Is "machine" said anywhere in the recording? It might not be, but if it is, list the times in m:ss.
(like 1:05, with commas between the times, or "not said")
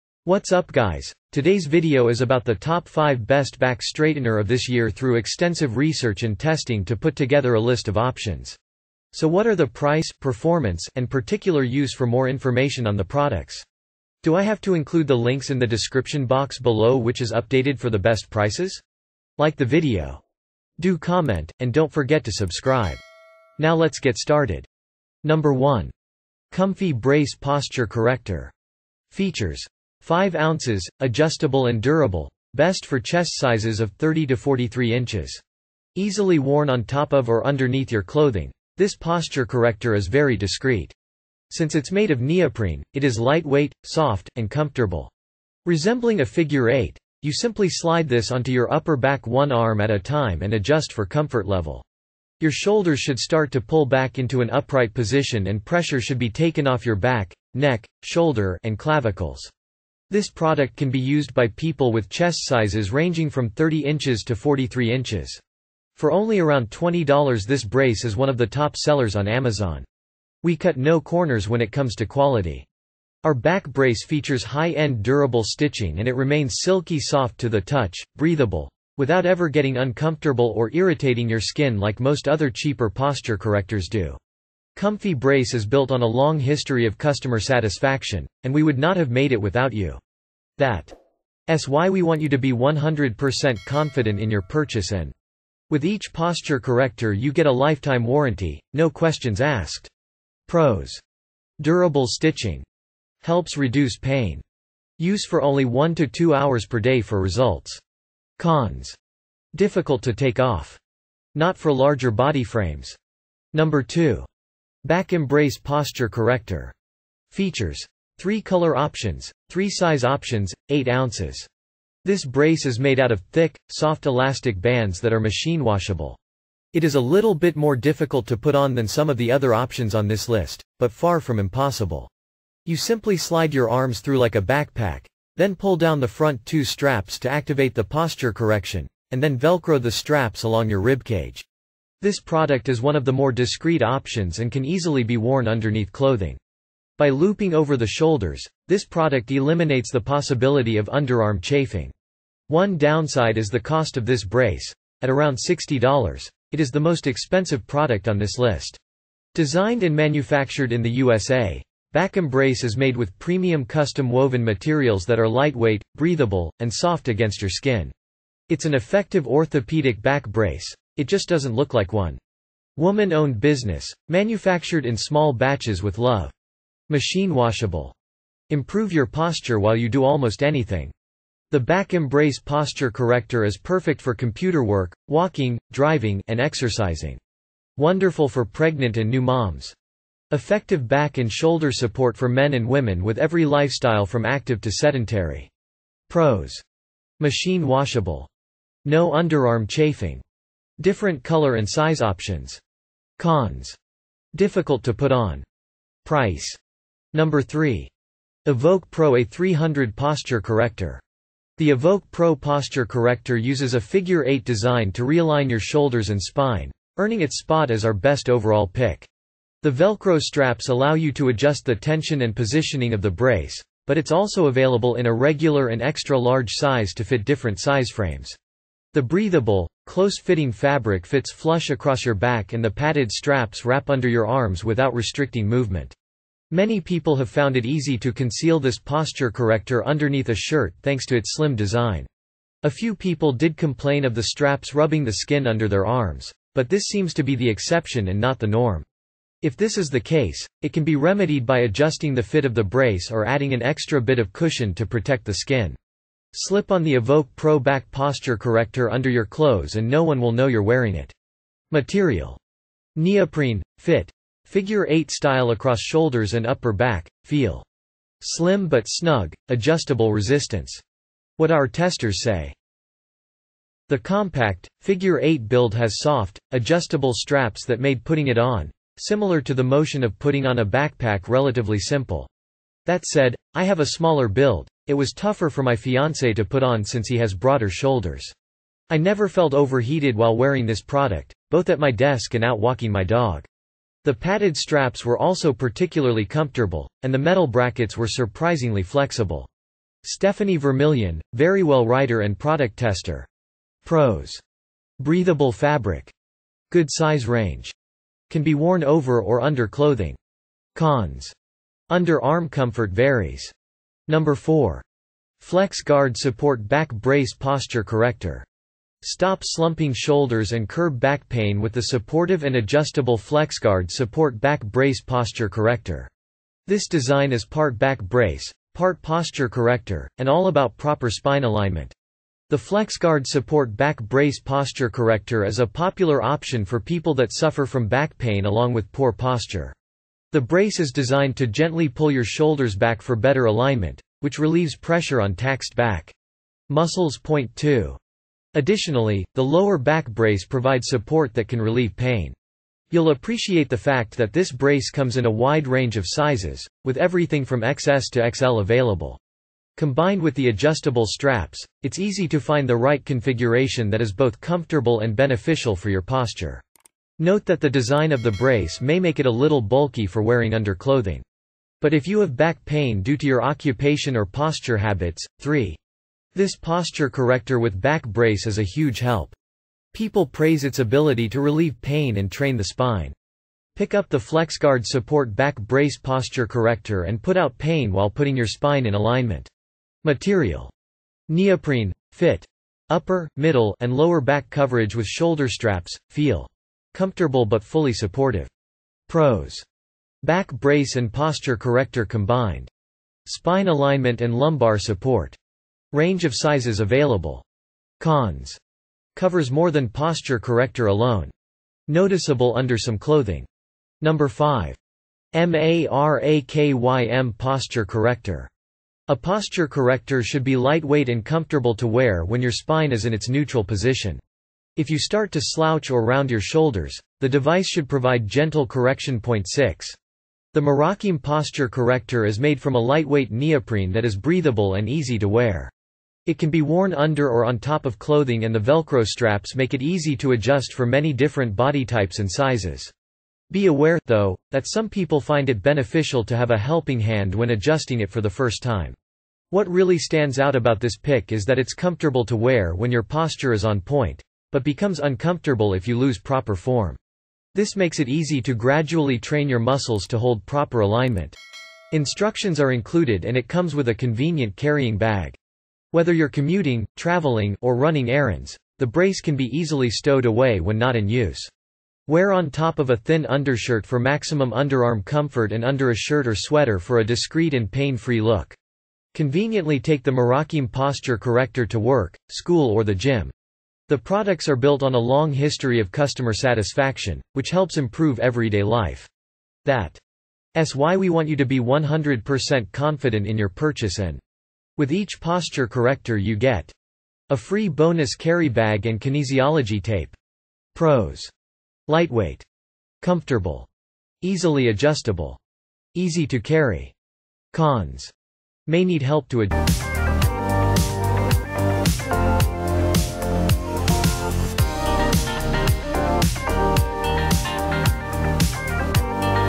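2:05, 2:56, 3:17.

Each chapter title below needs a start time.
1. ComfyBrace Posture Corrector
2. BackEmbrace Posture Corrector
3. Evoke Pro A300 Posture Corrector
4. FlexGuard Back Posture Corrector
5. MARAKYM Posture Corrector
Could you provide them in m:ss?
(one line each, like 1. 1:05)
1. 0:25
2. 2:27
3. 4:29
4. 5:43
5. 7:01.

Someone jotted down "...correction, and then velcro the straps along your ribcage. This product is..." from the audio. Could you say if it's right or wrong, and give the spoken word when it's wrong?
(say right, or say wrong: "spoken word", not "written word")
right.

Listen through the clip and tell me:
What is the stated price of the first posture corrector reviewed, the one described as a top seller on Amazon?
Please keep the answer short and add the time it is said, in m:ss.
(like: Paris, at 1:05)
$20, at 1:06.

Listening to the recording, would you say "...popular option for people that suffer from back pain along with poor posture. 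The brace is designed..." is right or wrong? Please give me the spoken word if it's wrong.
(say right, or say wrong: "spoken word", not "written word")
right.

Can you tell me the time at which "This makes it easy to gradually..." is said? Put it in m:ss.
7:37.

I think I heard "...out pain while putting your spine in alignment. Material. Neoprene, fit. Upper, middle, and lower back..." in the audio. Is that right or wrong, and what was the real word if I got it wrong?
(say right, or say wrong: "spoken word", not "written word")
right.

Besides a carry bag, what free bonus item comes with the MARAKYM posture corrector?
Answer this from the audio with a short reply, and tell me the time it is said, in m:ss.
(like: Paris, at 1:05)
kinesiology tape, at 8:18.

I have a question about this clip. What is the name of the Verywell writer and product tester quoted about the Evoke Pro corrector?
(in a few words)
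Stephanie Vermilion.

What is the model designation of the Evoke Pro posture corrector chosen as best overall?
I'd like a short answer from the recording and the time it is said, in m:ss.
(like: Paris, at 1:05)
A300, at 3:29.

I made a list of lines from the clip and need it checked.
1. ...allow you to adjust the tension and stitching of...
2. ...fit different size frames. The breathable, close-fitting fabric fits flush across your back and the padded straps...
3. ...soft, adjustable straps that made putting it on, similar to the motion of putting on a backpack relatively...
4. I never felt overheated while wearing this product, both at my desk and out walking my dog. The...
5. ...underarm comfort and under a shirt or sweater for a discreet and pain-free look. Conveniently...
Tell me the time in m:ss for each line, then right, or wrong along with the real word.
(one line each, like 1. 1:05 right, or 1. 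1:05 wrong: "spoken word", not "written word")
1. 3:40 wrong: "positioning", not "stitching"
2. 3:47 right
3. 4:36 right
4. 4:48 right
5. 7:54 right.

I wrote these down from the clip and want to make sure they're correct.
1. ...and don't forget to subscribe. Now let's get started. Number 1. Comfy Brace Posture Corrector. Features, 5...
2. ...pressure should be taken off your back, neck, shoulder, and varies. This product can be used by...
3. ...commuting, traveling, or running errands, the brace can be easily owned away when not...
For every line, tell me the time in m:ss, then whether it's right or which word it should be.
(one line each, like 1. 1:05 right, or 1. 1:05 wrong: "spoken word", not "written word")
1. 0:21 right
2. 0:55 wrong: "clavicles", not "varies"
3. 7:46 wrong: "stowed", not "owned".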